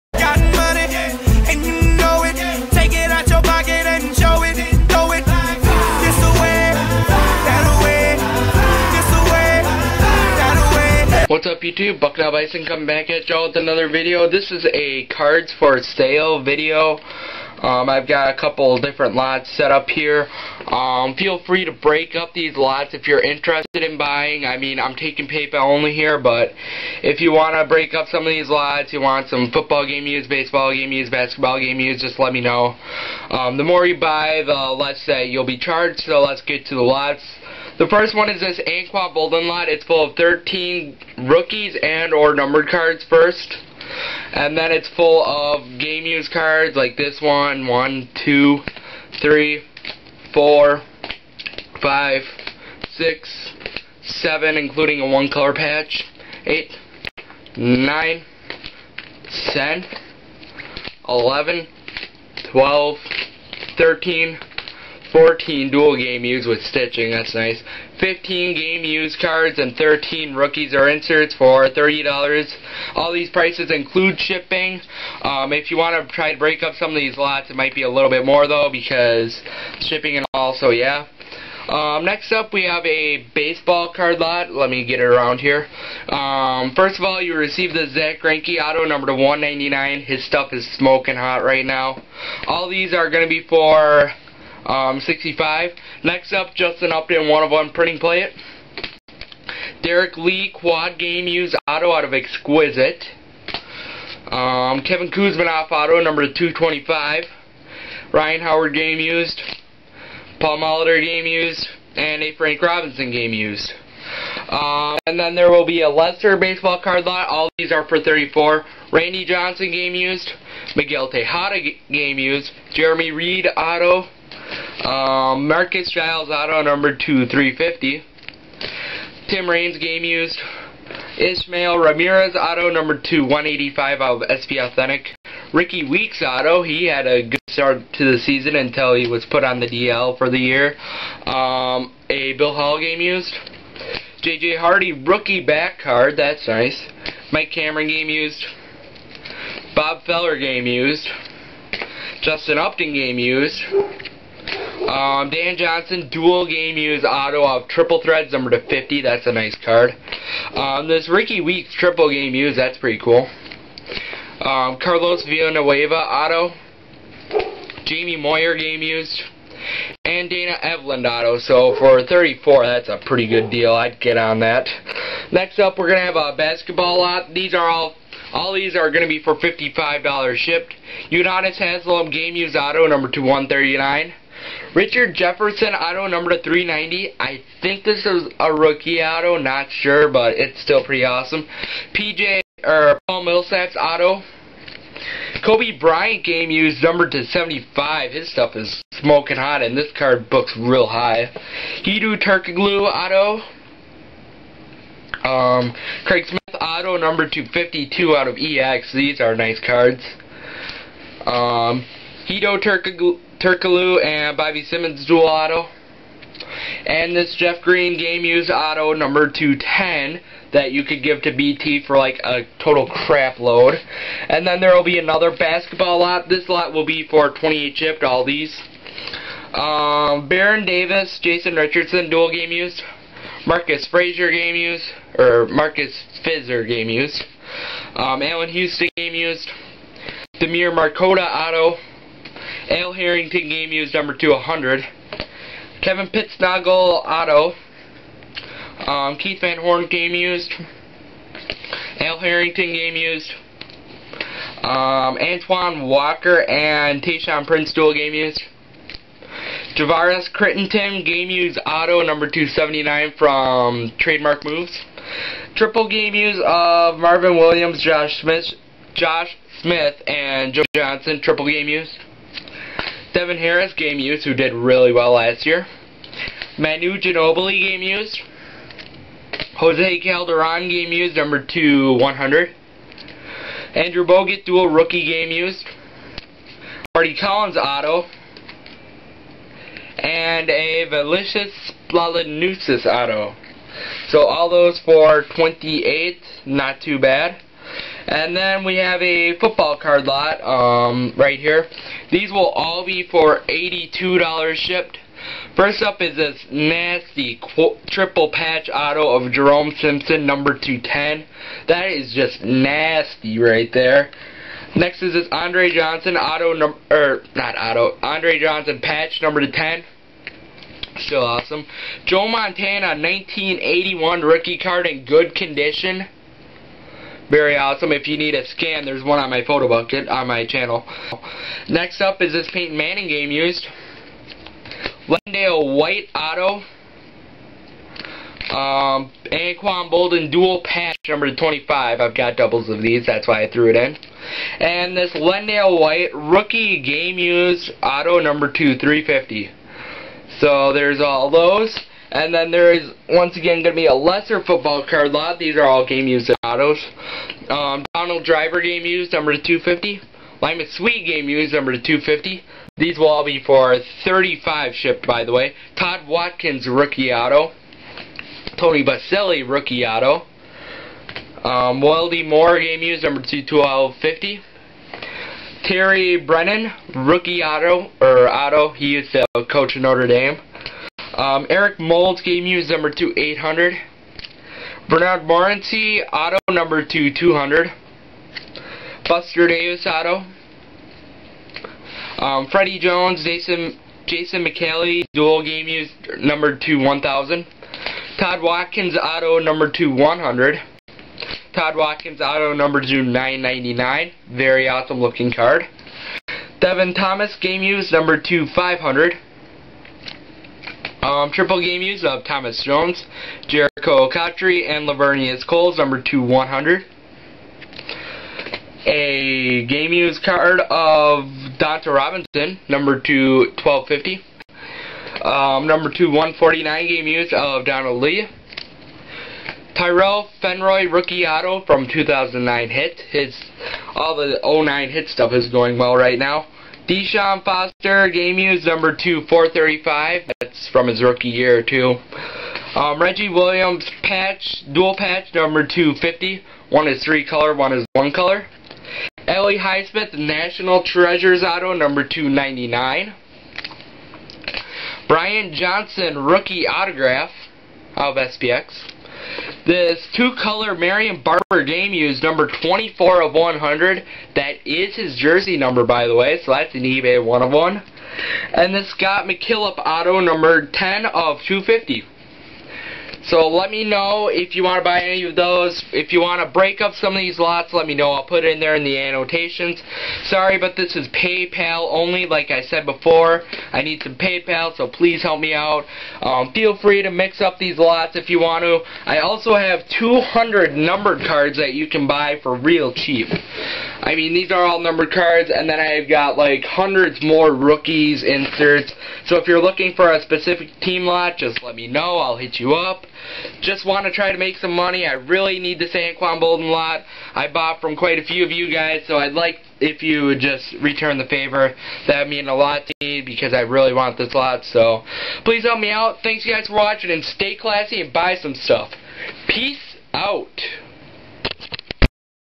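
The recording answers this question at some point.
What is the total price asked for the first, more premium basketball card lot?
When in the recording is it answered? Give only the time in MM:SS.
02:59.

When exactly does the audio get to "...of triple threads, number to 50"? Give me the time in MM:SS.
02:37.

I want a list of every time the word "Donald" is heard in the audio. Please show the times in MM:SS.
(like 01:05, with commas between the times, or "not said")
05:57, 07:07.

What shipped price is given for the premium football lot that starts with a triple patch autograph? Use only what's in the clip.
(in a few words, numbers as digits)
$82.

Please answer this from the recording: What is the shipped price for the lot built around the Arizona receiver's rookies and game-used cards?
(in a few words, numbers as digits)
$30.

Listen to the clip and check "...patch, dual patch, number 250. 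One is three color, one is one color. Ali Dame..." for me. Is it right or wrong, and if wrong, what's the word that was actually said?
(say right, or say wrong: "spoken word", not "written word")
wrong: "Highsmith", not "Dame".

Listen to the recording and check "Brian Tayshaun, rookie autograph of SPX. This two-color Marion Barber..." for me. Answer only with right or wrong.
wrong.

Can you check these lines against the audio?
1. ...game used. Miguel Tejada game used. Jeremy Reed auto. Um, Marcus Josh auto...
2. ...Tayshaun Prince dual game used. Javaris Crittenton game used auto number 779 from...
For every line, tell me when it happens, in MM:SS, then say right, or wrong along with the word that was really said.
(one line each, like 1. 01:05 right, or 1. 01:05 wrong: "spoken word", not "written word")
1. 01:59 wrong: "Giles", not "Josh"
2. 04:17 wrong: "279", not "779".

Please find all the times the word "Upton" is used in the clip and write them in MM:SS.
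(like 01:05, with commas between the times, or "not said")
01:36, 02:32.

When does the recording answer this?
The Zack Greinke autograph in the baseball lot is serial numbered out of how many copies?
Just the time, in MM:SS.
01:29.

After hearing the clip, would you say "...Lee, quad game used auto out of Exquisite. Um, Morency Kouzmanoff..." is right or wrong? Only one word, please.
wrong.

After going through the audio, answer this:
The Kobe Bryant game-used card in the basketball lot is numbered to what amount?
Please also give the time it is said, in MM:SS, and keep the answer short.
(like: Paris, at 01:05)
75, at 03:17.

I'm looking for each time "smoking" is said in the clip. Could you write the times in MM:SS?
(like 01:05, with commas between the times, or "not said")
01:30, 03:18.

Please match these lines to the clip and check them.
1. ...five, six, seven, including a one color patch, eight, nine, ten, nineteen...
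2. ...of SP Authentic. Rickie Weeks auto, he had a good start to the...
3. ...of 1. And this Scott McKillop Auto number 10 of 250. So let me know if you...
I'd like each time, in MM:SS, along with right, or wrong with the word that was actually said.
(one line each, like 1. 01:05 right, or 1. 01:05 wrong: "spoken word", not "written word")
1. 00:51 wrong: "eleven", not "nineteen"
2. 02:14 right
3. 07:47 right.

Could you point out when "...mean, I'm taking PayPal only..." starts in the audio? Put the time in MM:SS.
00:24.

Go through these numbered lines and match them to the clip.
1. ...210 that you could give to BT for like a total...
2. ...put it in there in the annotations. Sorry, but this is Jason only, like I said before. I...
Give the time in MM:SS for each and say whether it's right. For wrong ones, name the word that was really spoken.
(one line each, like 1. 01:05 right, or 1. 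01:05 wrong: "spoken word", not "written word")
1. 03:39 right
2. 07:58 wrong: "PayPal", not "Jason".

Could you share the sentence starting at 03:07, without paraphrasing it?
I think this is a rookie auto, not sure, but it's still pretty awesome.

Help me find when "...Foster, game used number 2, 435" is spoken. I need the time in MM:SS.
07:17.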